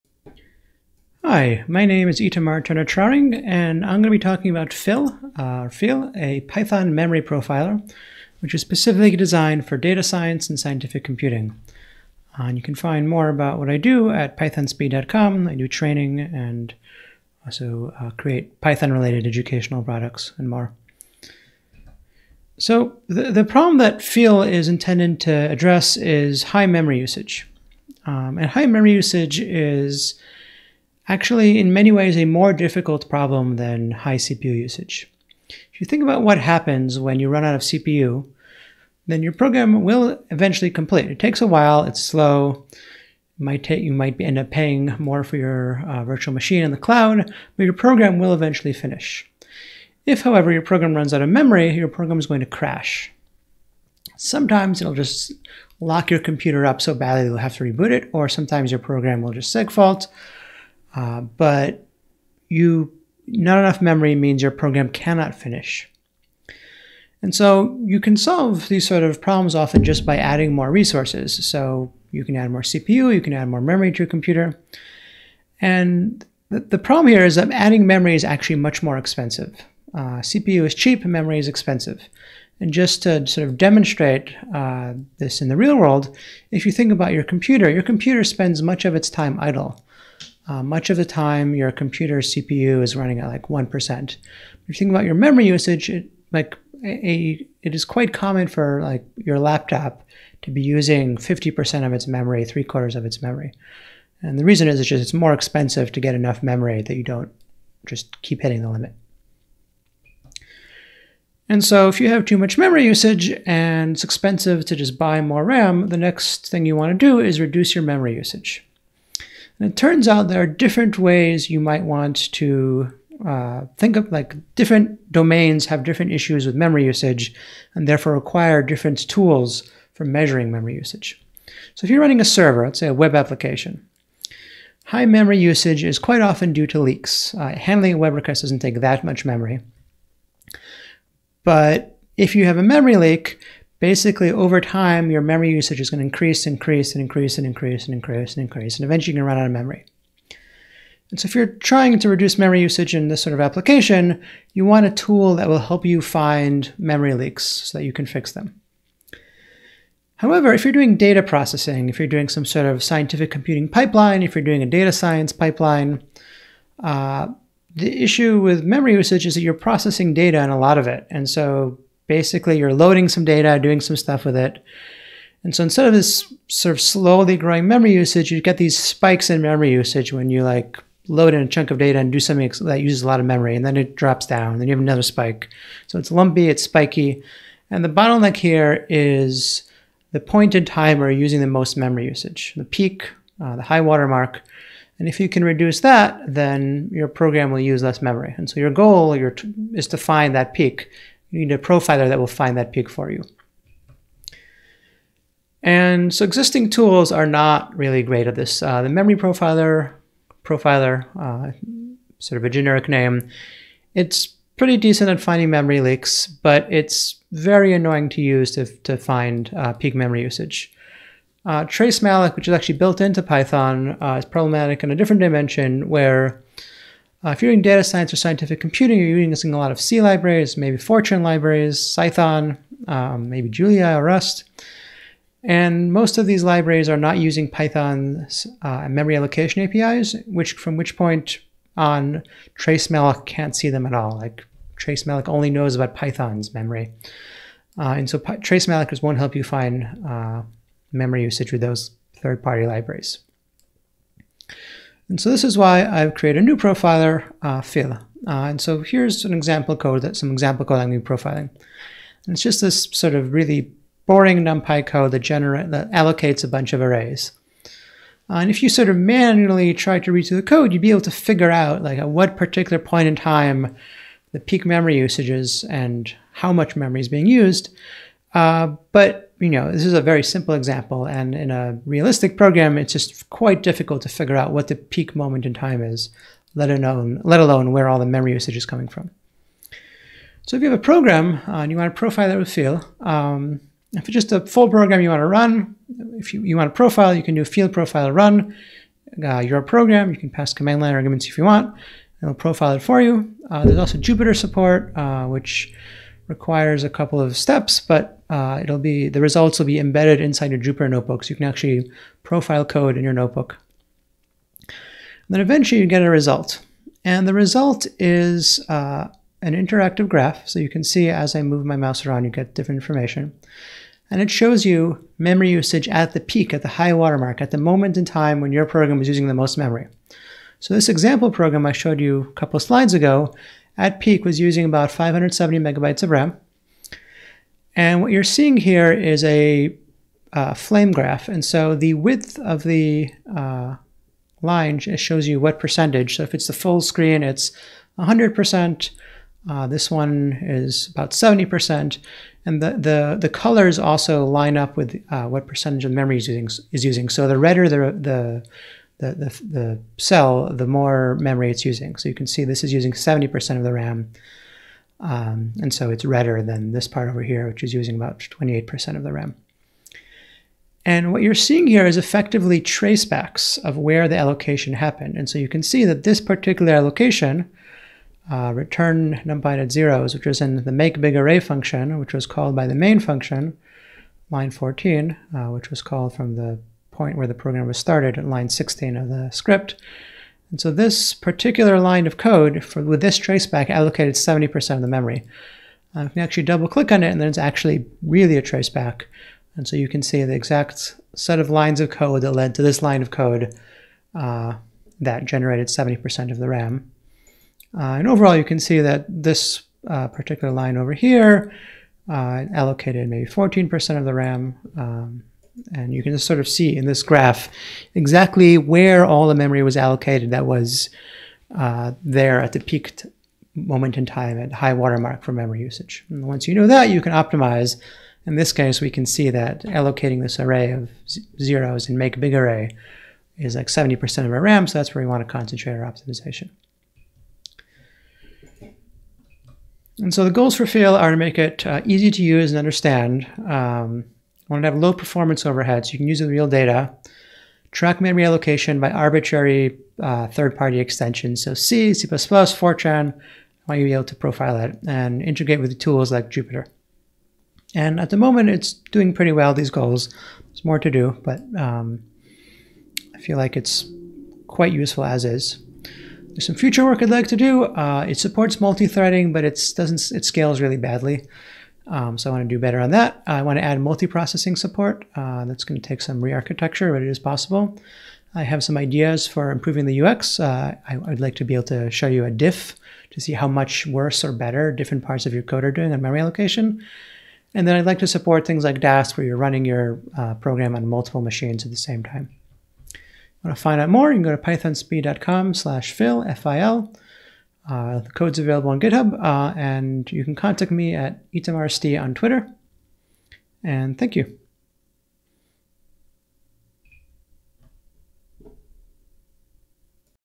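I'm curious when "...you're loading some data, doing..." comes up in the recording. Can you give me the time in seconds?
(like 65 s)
172 s.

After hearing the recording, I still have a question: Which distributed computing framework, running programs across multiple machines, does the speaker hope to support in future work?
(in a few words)
Dask.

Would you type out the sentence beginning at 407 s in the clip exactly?
Uh, and overall, you can see that this uh, particular line over here uh, allocated maybe 14% of the RAM.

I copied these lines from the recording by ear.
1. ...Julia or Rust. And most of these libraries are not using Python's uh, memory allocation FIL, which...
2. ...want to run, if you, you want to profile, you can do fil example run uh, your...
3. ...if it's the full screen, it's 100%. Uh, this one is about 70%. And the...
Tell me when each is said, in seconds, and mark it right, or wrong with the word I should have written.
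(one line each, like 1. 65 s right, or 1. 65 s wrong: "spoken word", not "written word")
1. 233 s wrong: "APIs", not "FIL"
2. 295 s wrong: "profile", not "example"
3. 346 s right.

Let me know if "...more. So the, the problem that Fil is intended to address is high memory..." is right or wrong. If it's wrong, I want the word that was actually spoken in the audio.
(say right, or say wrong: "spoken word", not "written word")
right.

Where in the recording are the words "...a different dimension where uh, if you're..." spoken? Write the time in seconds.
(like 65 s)
224 s.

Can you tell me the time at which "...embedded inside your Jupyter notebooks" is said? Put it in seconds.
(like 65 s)
309 s.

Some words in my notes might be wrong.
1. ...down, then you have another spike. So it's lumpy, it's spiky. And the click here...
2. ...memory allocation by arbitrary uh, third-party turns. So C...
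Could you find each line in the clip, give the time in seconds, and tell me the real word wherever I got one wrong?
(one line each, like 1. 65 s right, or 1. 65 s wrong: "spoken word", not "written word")
1. 184 s wrong: "bottleneck", not "click"
2. 448 s wrong: "extensions", not "turns".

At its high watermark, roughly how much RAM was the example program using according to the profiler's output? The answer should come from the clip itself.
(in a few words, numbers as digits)
570 megabytes.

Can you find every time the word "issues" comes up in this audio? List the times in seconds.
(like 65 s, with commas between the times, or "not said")
126 s, 168 s.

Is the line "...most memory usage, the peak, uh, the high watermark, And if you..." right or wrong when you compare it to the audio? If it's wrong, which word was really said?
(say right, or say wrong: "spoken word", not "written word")
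right.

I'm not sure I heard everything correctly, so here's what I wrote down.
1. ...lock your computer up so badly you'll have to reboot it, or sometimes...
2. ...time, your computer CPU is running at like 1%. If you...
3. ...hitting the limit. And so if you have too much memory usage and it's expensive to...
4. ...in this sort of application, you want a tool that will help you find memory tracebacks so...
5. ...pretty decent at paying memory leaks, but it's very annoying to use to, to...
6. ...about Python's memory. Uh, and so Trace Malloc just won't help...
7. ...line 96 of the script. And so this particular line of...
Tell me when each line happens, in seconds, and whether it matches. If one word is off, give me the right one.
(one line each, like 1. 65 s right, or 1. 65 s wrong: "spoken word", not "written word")
1. 55 s right
2. 91 s right
3. 108 s right
4. 152 s wrong: "leaks", not "tracebacks"
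5. 214 s wrong: "finding", not "paying"
6. 245 s right
7. 388 s wrong: "16", not "96".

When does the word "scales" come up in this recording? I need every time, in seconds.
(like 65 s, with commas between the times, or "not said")
470 s.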